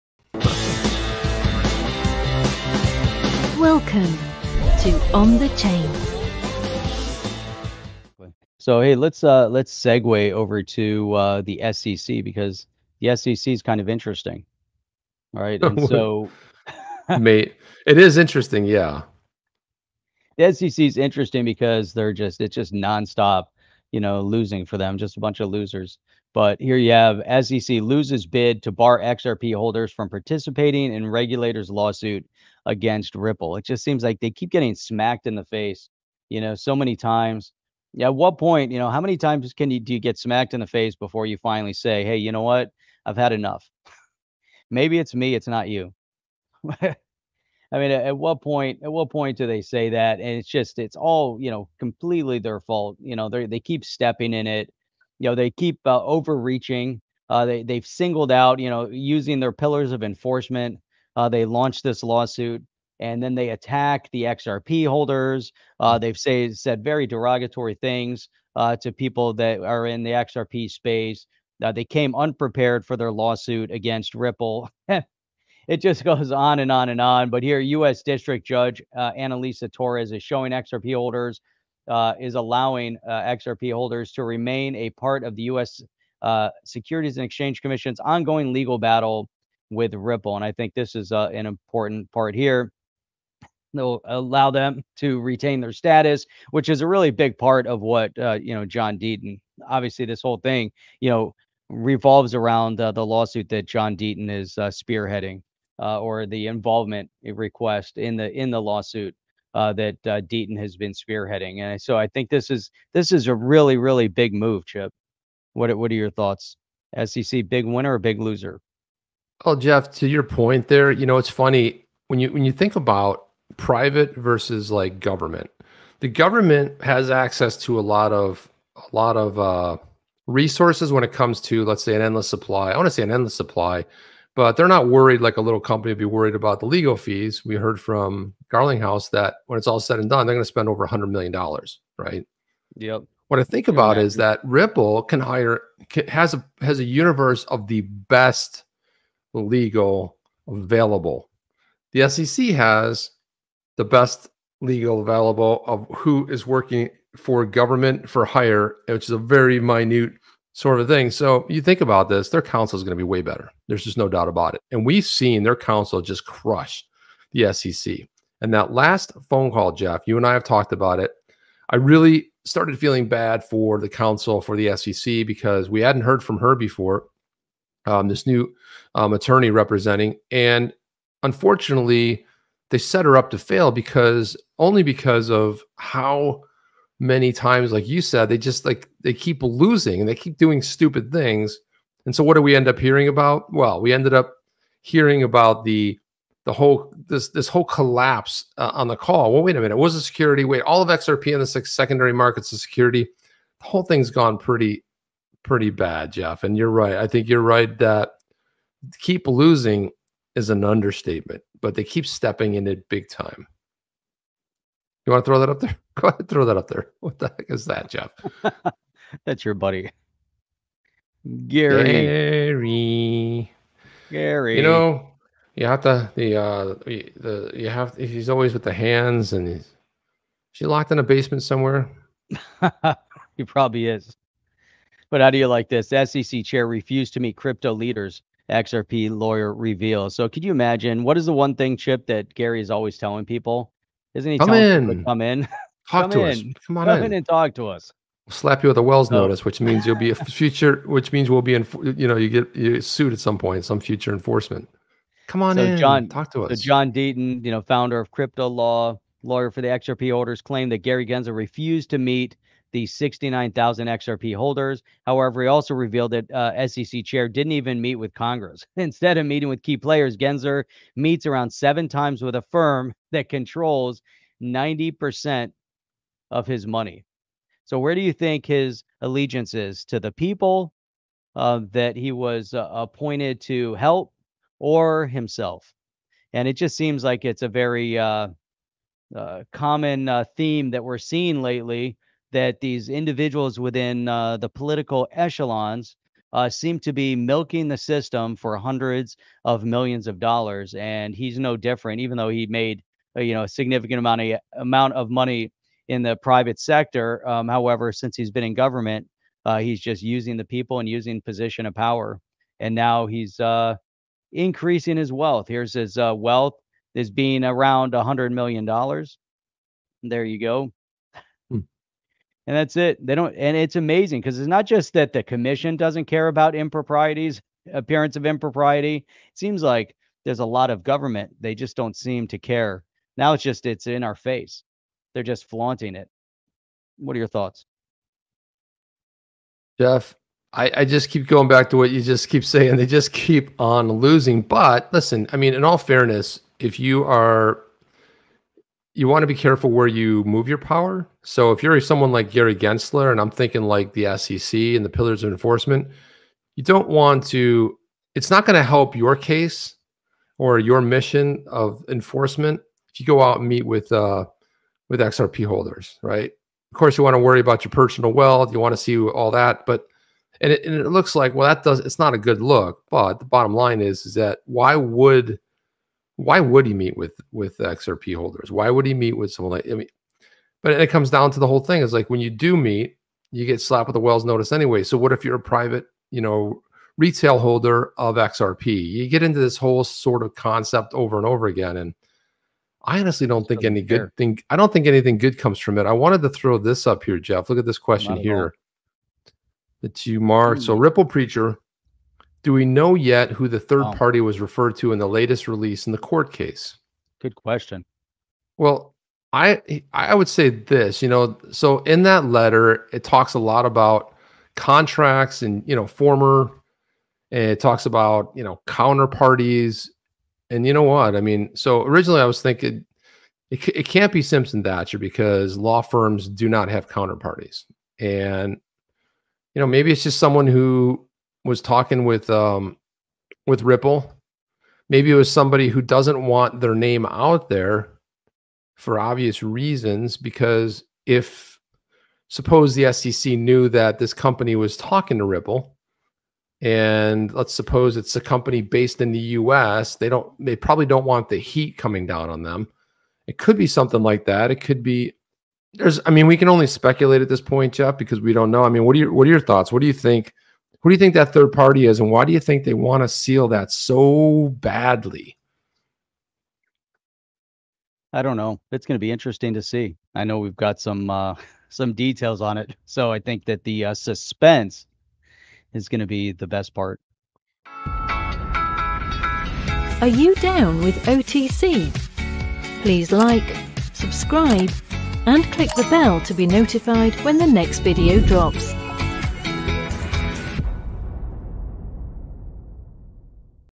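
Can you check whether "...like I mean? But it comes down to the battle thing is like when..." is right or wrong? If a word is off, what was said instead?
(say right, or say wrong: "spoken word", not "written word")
wrong: "whole", not "battle".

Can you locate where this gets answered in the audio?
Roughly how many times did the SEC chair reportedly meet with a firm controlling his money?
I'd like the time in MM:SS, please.
04:31.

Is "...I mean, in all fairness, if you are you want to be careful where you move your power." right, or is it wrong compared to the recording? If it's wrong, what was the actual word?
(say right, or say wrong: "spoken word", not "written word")
right.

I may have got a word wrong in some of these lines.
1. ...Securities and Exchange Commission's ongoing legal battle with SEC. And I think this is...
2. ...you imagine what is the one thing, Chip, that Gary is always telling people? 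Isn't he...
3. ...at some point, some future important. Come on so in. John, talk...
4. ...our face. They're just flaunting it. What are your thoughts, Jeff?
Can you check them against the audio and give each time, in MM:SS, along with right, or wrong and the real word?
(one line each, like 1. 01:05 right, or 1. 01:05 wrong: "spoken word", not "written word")
1. 01:26 wrong: "Ripple", not "SEC"
2. 04:00 right
3. 04:13 wrong: "enforcement", not "important"
4. 05:34 right.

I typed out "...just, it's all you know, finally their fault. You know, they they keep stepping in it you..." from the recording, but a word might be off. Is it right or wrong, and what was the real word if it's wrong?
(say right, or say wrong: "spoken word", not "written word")
wrong: "completely", not "finally".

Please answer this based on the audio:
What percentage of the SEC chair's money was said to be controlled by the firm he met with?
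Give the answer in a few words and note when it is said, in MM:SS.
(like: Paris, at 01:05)
90%, at 04:34.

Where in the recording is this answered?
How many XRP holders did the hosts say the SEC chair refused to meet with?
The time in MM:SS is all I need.
04:22.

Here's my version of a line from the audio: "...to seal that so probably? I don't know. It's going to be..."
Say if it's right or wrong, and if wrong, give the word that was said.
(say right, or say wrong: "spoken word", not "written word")
wrong: "badly", not "probably".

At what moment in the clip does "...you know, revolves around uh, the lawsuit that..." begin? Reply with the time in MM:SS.
01:40.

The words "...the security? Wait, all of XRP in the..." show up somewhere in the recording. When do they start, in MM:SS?
03:19.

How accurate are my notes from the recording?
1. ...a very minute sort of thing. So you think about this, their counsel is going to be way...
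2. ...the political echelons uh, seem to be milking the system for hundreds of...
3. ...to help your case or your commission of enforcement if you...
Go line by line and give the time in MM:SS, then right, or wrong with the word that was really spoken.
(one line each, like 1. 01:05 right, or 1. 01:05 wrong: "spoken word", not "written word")
1. 02:39 right
2. 04:54 right
3. 05:58 wrong: "mission", not "commission".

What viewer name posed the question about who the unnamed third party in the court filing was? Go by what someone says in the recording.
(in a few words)
Ripple Preacher.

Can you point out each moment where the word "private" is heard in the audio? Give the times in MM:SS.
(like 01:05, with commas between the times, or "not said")
02:03, 05:06, 06:25.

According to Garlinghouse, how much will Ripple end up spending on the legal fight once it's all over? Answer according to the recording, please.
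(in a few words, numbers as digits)
over $100 million.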